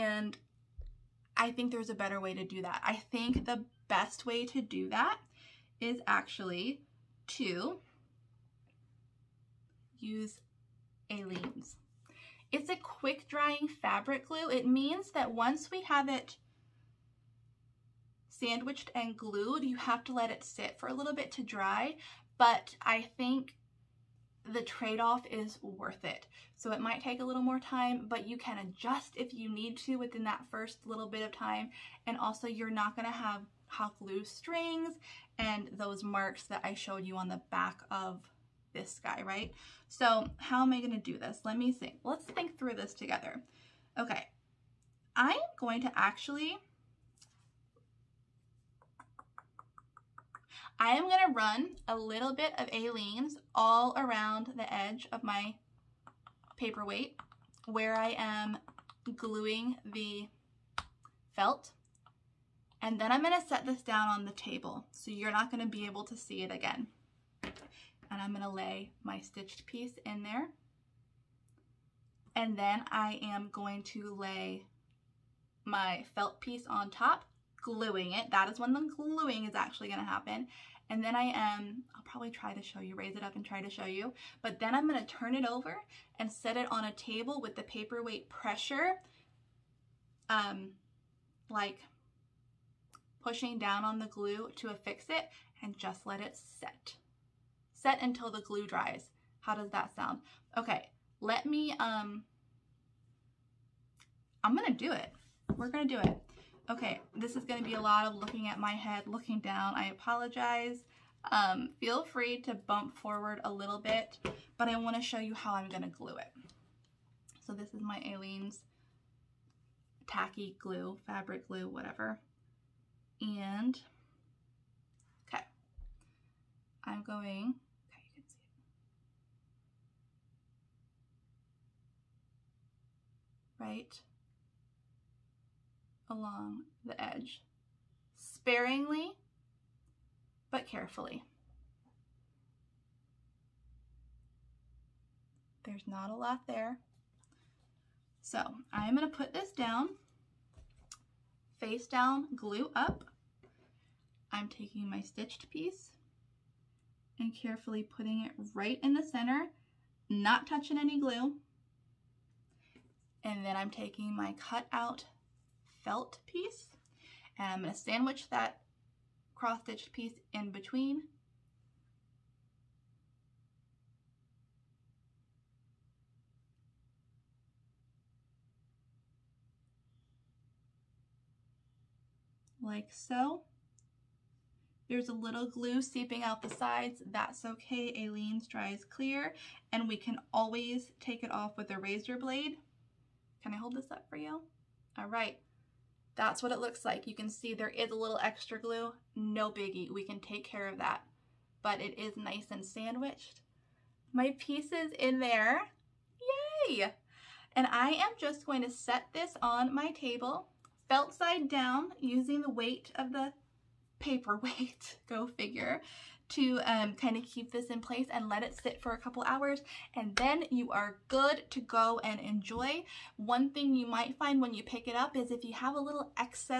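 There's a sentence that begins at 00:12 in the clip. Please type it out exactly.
It's a quick drying fabric glue.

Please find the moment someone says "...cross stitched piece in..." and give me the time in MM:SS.
02:49.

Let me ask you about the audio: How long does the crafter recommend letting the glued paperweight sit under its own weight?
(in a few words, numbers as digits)
a couple hours.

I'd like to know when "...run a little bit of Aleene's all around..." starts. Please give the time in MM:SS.
00:51.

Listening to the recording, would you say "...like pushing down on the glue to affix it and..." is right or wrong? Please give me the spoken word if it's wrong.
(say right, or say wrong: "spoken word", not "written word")
right.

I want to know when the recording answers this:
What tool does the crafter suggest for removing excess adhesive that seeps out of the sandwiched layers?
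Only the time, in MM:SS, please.
03:11.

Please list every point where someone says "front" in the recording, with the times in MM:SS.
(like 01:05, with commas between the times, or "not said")
not said.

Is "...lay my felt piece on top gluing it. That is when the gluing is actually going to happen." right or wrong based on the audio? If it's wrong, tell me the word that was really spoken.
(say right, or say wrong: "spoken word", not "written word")
right.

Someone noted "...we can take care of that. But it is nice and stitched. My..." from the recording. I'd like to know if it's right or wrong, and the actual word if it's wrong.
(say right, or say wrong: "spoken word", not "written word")
wrong: "sandwiched", not "stitched".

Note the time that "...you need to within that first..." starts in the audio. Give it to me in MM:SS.
00:29.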